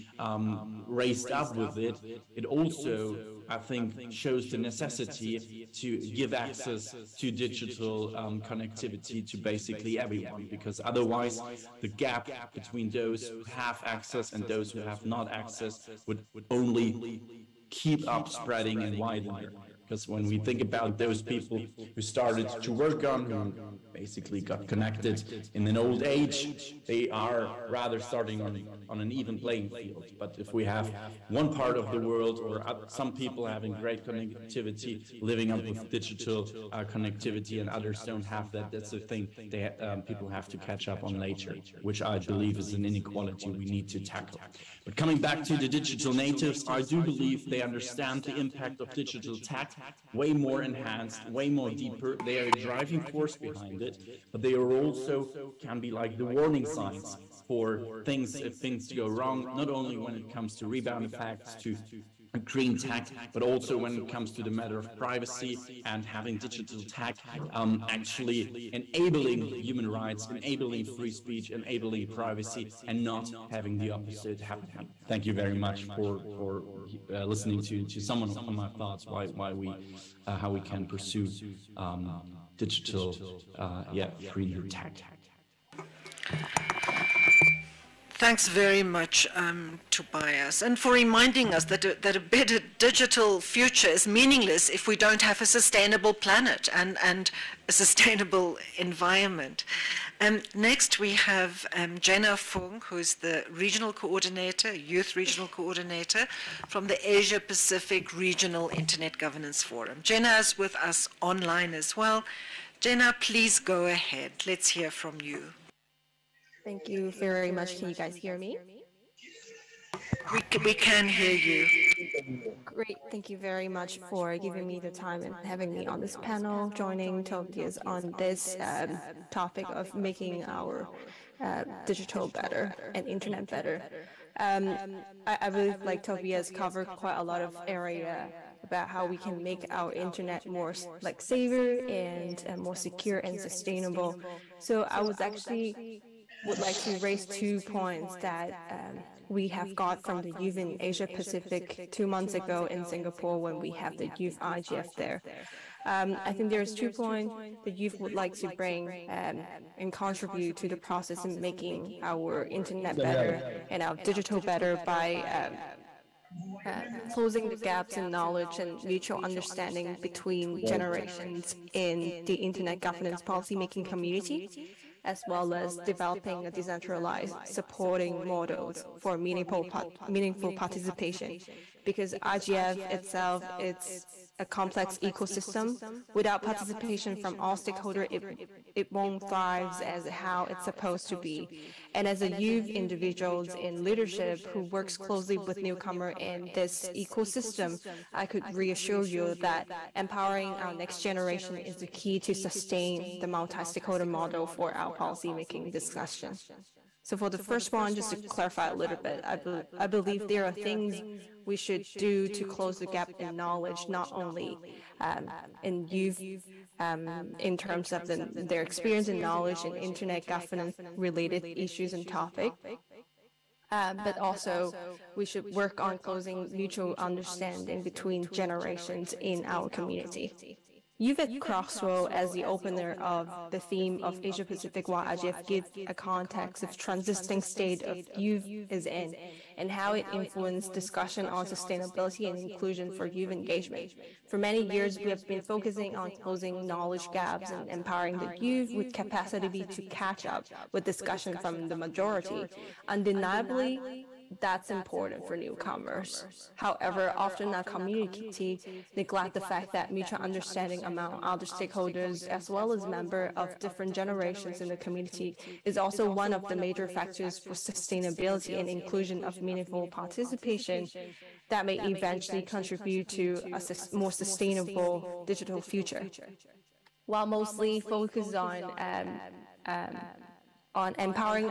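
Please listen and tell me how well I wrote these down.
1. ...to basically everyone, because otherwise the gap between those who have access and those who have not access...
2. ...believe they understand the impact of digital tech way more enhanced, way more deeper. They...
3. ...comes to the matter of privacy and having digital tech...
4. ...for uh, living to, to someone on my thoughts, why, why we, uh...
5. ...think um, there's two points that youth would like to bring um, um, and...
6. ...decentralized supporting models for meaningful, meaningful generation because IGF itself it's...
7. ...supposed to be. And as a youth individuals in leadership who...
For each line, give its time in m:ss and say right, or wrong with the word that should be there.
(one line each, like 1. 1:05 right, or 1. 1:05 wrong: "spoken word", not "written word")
1. 0:09 right
2. 0:47 right
3. 1:04 right
4. 1:16 wrong: "listening", not "living"
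5. 2:36 right
6. 2:56 wrong: "participation", not "generation"
7. 3:10 right.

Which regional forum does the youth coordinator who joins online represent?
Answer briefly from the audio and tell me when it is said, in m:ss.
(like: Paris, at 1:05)
Asia Pacific Regional Internet Governance Forum, at 1:47.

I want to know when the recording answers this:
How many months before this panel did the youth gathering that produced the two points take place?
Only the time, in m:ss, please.
2:31.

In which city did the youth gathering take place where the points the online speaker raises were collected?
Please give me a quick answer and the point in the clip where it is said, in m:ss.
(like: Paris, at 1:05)
Singapore, at 2:32.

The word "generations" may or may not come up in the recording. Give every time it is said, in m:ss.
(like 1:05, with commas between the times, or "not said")
2:50, 3:21, 3:48, 4:23.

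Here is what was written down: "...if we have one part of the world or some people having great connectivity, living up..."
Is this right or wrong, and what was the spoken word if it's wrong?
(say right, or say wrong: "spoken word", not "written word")
right.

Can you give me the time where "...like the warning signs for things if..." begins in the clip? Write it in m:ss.
0:55.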